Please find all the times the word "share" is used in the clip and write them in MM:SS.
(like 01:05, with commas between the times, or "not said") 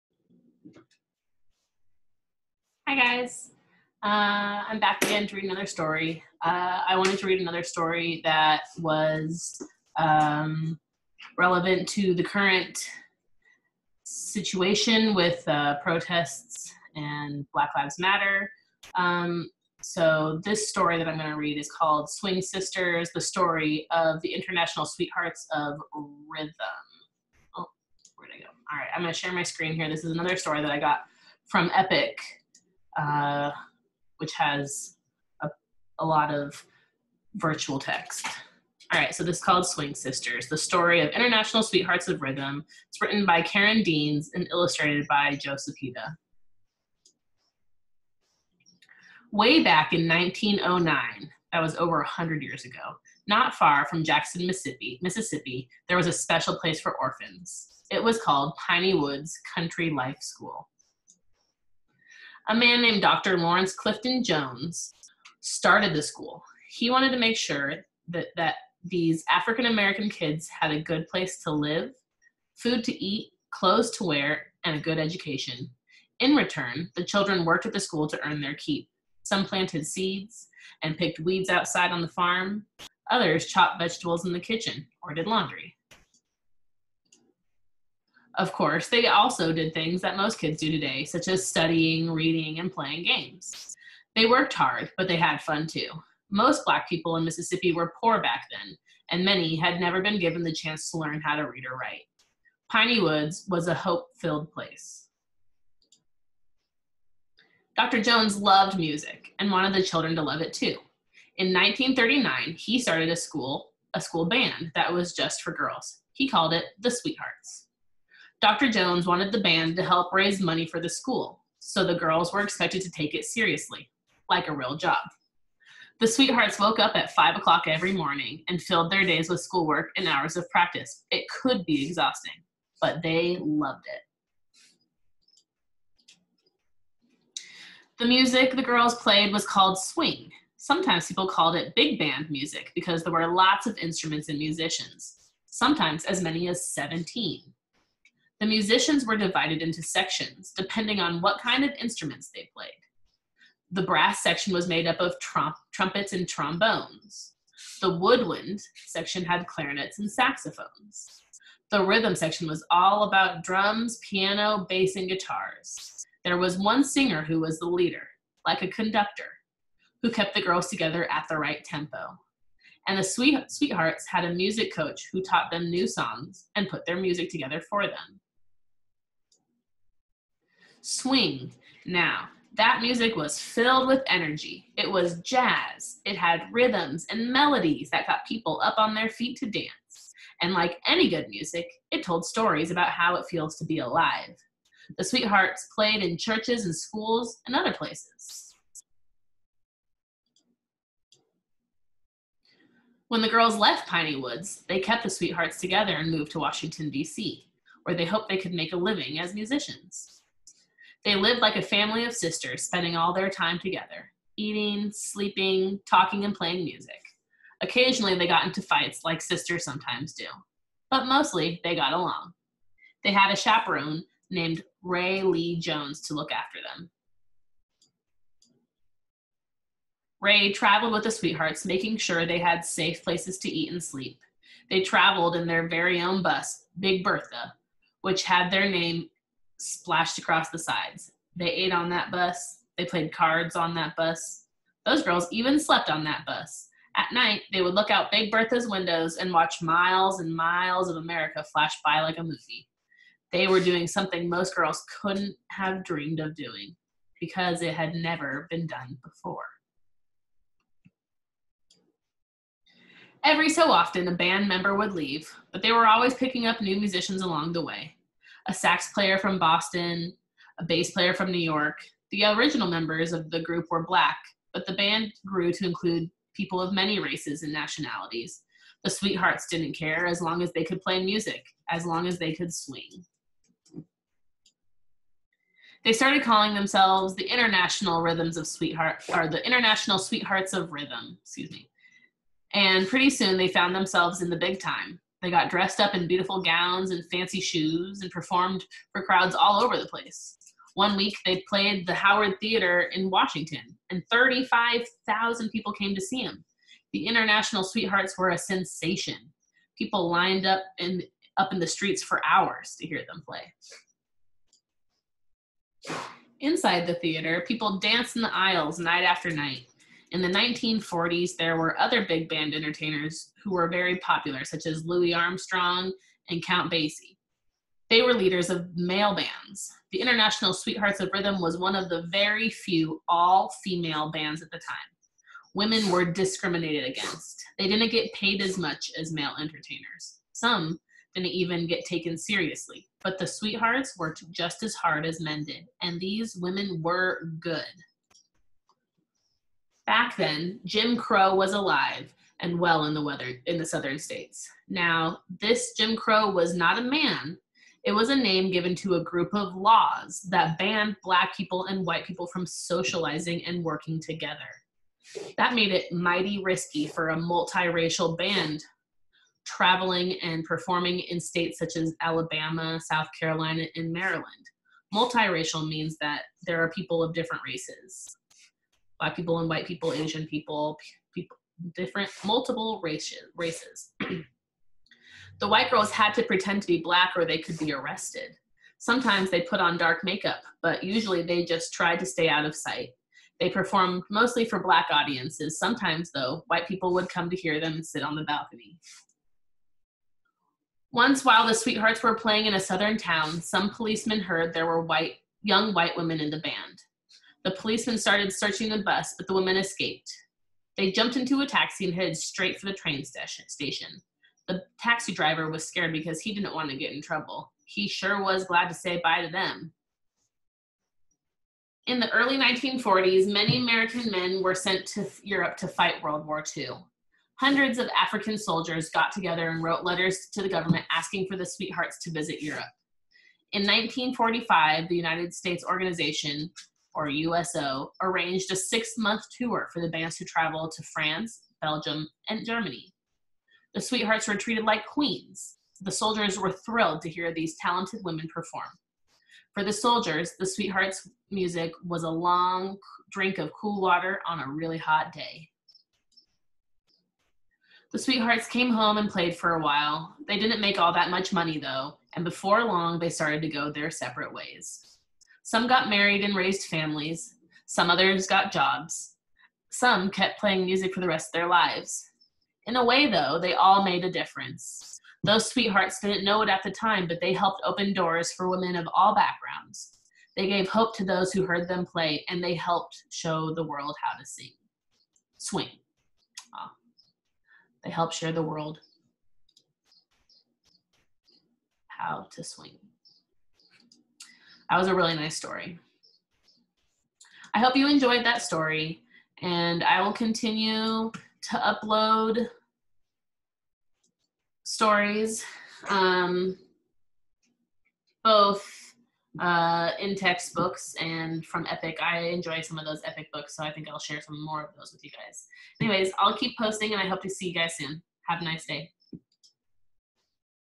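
00:29, 08:08, 08:33.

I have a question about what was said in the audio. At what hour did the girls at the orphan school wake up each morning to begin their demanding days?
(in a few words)
5 o'clock.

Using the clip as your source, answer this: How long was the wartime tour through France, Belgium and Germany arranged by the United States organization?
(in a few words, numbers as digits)
6 months.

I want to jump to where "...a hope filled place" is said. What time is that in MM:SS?
01:43.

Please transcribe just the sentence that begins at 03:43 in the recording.
They had a chaperone named Rae Lee Jones to look after them.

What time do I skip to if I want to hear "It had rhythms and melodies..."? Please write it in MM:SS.
03:06.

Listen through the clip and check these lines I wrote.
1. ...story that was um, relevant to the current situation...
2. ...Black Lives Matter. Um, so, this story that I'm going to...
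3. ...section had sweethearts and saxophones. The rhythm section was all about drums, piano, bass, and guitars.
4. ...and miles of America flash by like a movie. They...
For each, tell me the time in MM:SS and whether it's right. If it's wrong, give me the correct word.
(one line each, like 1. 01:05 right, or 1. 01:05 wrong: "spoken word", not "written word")
1. 00:07 right
2. 00:17 right
3. 02:38 wrong: "clarinets", not "sweethearts"
4. 04:10 right.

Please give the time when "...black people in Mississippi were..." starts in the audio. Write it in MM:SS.
01:36.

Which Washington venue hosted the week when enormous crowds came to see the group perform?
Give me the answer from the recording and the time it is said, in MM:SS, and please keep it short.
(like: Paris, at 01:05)
Howard Theater, at 05:01.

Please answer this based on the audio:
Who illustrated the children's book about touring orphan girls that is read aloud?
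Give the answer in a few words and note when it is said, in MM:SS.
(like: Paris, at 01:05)
Joe Cepeda, at 00:45.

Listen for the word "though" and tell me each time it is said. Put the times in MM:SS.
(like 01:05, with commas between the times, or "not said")
06:36, 07:41, 07:53.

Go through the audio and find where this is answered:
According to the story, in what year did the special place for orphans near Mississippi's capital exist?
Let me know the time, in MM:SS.
00:50.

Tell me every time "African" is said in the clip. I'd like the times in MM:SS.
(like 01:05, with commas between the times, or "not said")
01:09, 07:07.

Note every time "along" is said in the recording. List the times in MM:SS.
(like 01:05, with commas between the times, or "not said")
03:41, 04:27.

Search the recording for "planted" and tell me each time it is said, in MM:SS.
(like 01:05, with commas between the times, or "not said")
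01:19.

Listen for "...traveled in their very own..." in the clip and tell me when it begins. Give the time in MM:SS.
03:54.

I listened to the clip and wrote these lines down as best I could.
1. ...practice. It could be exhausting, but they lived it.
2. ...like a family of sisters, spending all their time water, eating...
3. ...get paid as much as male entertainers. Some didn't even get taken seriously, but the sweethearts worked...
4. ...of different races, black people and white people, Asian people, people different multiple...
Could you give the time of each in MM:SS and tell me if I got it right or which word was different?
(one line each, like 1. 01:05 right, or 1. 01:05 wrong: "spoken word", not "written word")
1. 02:10 wrong: "loved", not "lived"
2. 03:31 wrong: "together", not "water"
3. 05:37 right
4. 06:17 right.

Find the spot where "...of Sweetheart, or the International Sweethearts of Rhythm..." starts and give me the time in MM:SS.
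04:48.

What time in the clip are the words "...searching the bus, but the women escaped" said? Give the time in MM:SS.
06:48.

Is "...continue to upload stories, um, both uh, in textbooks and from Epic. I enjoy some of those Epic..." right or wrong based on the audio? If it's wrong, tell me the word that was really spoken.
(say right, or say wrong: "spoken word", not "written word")
right.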